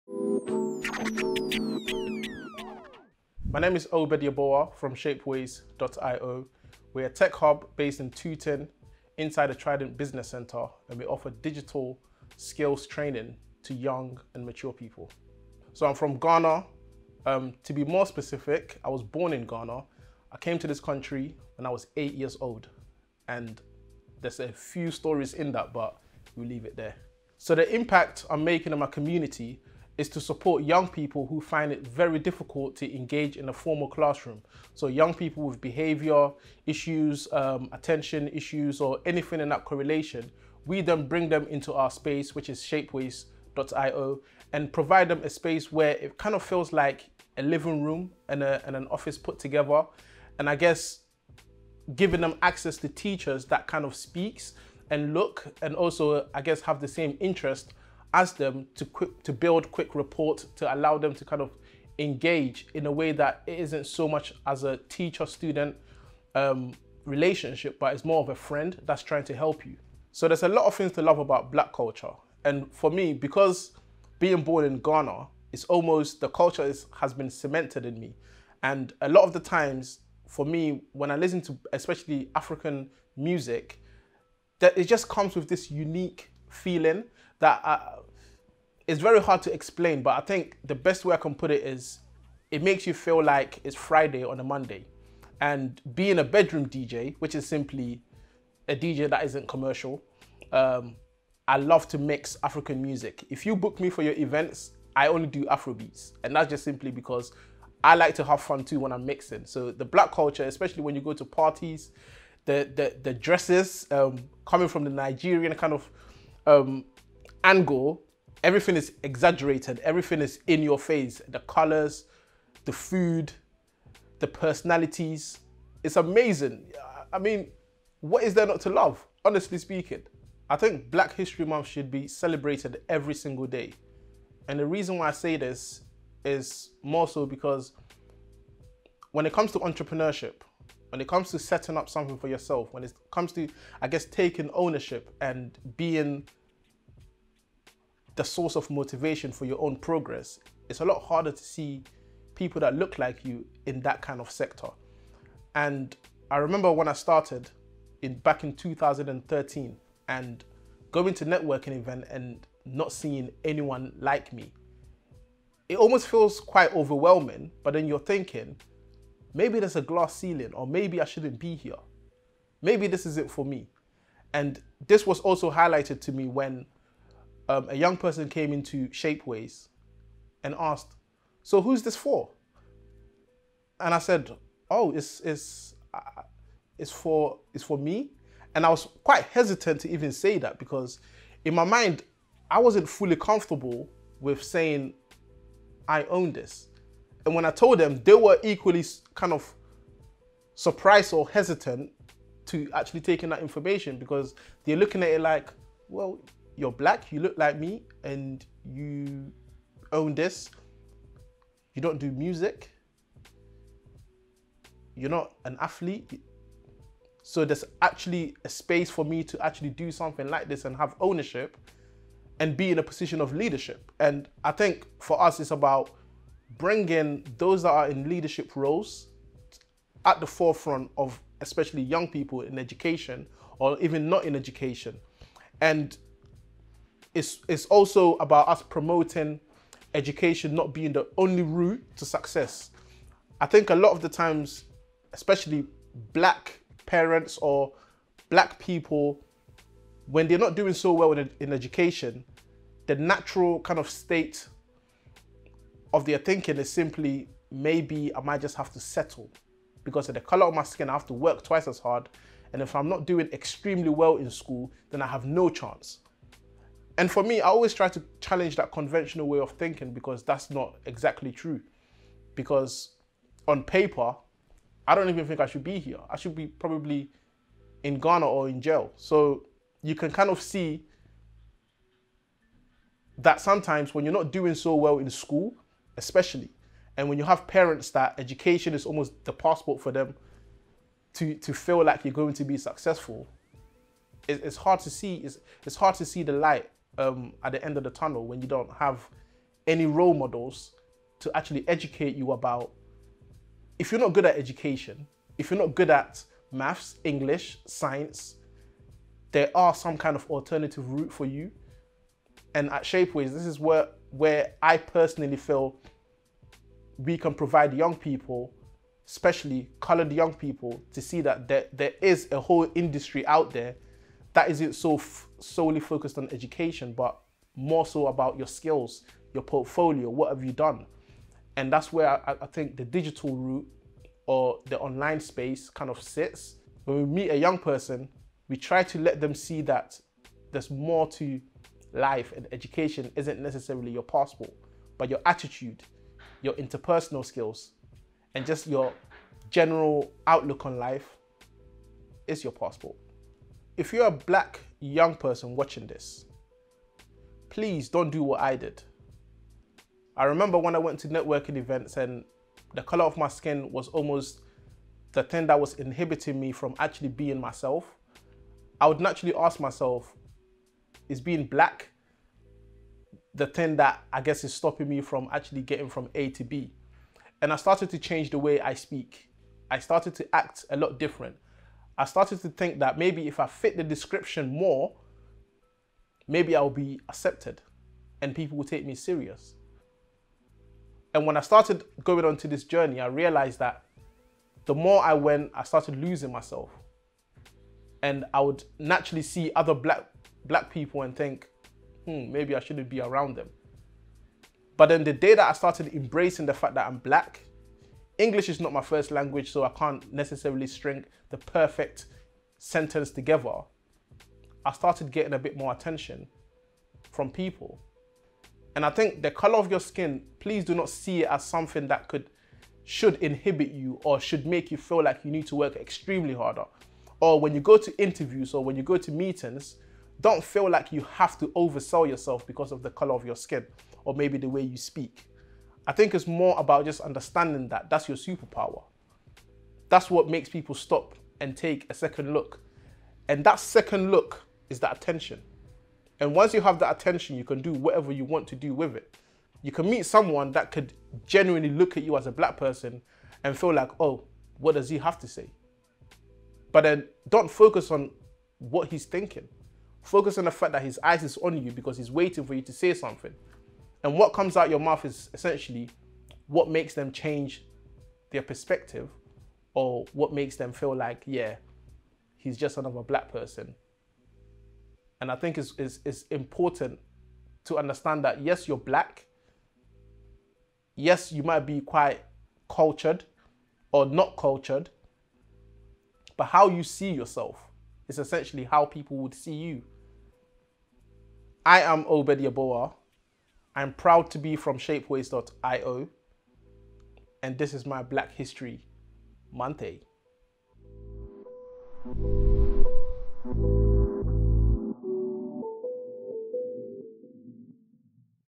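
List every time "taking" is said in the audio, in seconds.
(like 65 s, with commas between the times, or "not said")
144 s, 203 s.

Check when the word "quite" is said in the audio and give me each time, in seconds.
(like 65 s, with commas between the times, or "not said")
166 s, 189 s, 481 s.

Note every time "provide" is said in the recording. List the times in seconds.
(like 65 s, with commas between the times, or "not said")
44 s, 317 s.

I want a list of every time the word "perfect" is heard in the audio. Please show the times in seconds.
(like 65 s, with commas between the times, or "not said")
411 s.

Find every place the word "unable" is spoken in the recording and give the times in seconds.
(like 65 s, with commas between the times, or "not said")
not said.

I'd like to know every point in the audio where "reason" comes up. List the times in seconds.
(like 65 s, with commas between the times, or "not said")
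134 s.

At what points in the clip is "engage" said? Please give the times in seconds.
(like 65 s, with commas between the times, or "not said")
32 s, 61 s.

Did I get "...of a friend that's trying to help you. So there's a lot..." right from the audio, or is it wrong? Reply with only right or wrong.
right.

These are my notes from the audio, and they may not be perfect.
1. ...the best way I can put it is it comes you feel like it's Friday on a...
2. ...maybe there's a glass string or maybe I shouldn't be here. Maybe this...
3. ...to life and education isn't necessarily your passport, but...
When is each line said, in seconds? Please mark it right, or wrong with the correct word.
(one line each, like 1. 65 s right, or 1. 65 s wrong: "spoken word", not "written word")
1. 90 s wrong: "makes", not "comes"
2. 169 s wrong: "ceiling", not "string"
3. 341 s right.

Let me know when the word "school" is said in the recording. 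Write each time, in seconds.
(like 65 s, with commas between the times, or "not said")
264 s, 285 s.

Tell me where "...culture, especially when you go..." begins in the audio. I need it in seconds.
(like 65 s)
110 s.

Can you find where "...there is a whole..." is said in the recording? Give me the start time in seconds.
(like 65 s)
321 s.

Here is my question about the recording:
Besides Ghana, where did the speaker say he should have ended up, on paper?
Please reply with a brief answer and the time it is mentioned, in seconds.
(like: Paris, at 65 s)
jail, at 278 s.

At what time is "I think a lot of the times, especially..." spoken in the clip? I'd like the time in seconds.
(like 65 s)
243 s.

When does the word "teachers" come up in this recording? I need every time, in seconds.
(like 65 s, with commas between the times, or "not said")
52 s, 64 s.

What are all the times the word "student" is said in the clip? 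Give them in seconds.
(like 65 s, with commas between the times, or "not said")
65 s.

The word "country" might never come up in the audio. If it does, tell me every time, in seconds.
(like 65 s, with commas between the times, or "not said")
20 s.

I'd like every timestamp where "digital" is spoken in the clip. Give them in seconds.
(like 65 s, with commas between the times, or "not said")
11 s, 332 s.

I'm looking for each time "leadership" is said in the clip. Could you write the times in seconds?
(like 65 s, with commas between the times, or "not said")
223 s, 228 s.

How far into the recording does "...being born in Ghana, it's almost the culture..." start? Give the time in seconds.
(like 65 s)
74 s.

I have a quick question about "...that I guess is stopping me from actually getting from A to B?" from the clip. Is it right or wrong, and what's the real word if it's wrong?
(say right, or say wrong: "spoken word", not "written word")
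right.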